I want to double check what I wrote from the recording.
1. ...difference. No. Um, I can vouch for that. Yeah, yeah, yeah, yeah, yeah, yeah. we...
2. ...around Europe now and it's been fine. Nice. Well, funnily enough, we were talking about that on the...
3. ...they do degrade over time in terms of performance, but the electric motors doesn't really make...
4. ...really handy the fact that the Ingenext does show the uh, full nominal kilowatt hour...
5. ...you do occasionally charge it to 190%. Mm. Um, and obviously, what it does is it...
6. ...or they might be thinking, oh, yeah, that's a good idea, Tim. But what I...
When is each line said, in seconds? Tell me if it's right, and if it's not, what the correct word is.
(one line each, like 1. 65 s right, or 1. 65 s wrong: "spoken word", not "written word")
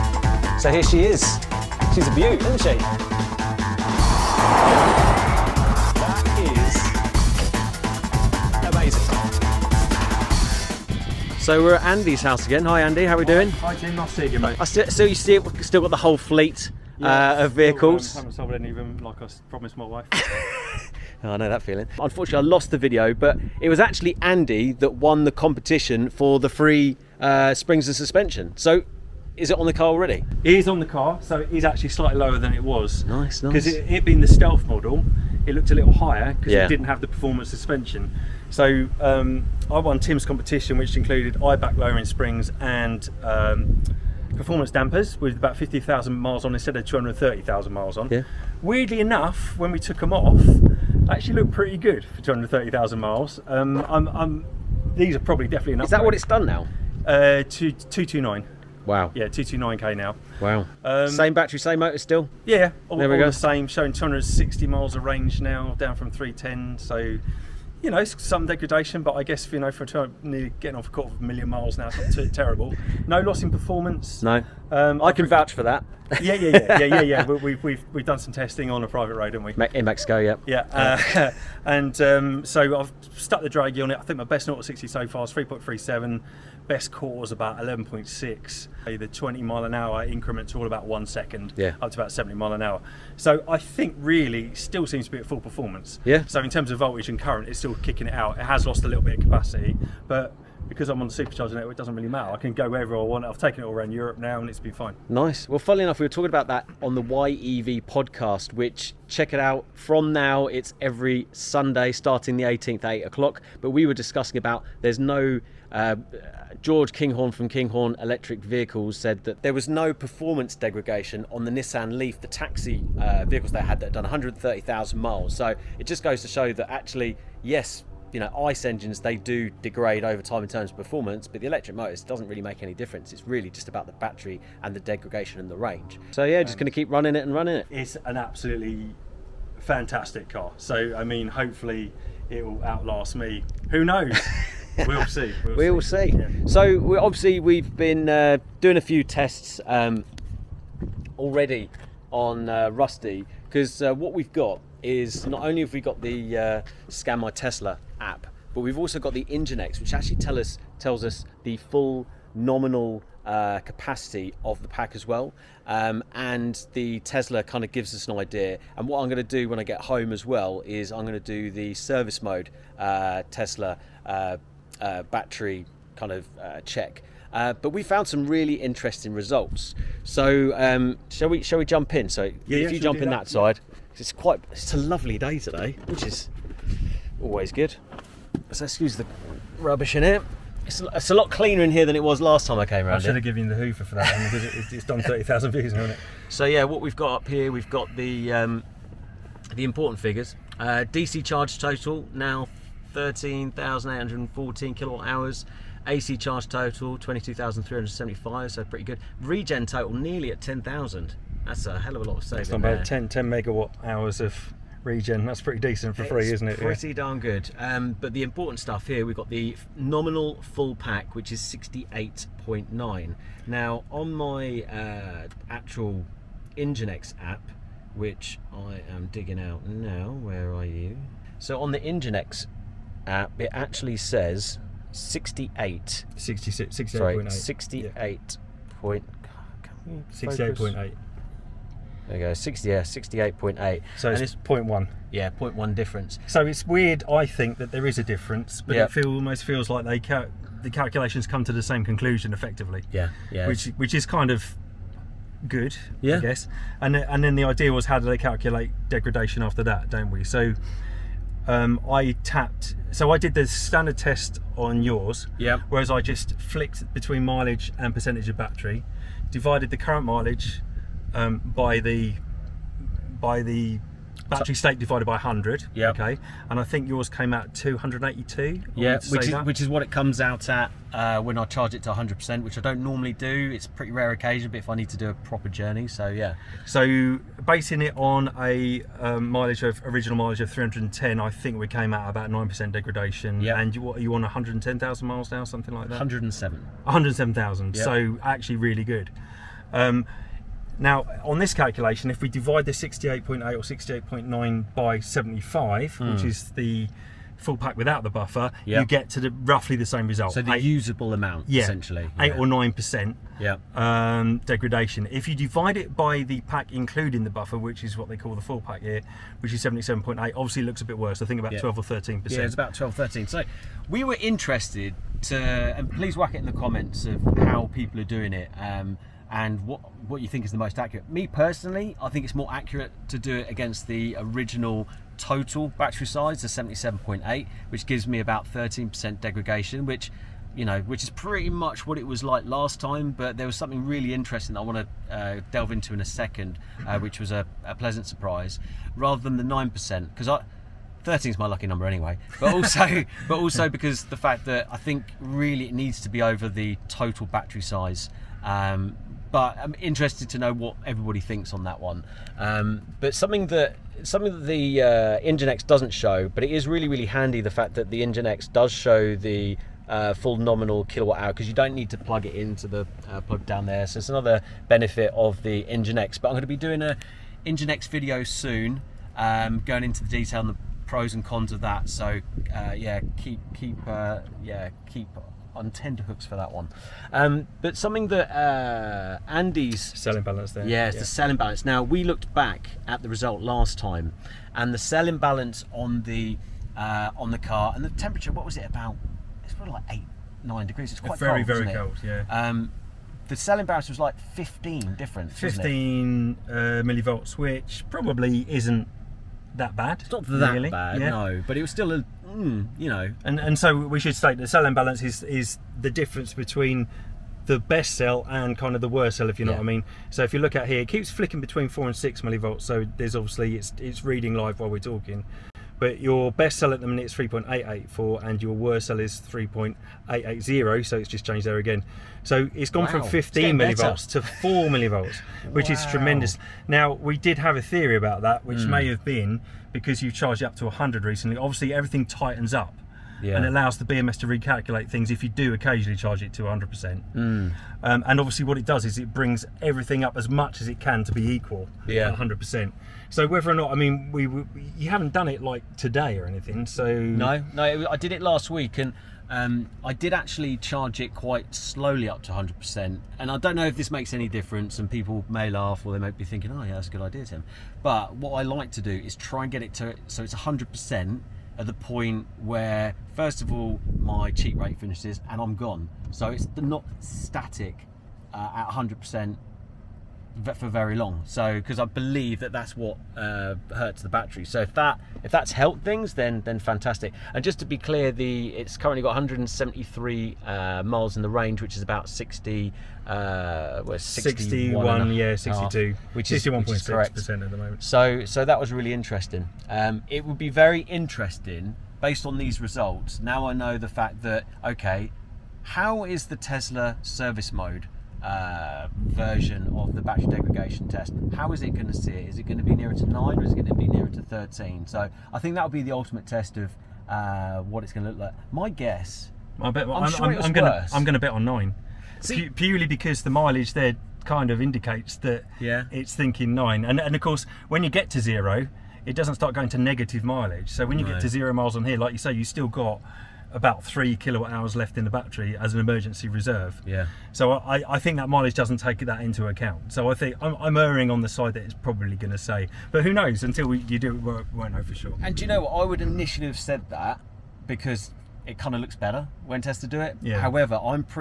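1. 73 s wrong: "performance", not "difference"
2. 103 s right
3. 128 s right
4. 366 s right
5. 445 s wrong: "100", not "190"
6. 465 s right.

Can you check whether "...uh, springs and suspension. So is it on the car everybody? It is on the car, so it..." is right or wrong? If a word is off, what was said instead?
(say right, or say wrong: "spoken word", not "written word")
wrong: "already", not "everybody".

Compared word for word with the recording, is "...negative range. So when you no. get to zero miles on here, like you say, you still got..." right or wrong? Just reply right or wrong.
wrong.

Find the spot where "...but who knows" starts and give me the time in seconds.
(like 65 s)
542 s.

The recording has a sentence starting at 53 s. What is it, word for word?
Um, I'm, I'm, these are probably definitely enough.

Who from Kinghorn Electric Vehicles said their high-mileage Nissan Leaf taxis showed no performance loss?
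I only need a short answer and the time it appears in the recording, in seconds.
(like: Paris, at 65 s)
George Kinghorn, at 116 s.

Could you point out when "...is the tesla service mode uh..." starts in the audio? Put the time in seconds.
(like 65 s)
506 s.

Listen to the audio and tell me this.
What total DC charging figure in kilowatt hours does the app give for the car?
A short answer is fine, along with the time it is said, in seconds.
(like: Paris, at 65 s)
13,814, at 202 s.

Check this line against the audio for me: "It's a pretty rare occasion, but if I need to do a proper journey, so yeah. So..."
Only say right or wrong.
right.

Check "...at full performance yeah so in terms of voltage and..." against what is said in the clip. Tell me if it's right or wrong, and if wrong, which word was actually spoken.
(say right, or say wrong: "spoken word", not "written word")
right.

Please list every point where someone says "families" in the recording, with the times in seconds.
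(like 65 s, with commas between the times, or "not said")
not said.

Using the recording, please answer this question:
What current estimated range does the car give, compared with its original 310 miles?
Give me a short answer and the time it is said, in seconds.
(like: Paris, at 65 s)
260 miles, at 63 s.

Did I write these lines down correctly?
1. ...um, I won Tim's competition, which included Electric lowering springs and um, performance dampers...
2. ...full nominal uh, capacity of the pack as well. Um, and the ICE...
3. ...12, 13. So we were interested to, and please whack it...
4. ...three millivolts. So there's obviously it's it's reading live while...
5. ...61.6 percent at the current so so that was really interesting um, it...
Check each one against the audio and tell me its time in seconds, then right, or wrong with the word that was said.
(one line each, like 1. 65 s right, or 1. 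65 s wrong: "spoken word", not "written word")
1. 38 s wrong: "Eibach", not "Electric"
2. 161 s wrong: "Tesla", not "ICE"
3. 322 s right
4. 421 s wrong: "six", not "three"
5. 496 s wrong: "moment", not "current".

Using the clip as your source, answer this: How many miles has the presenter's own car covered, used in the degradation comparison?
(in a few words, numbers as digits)
107,000.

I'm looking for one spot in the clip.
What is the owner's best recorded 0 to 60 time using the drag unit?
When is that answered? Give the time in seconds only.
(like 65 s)
85 s.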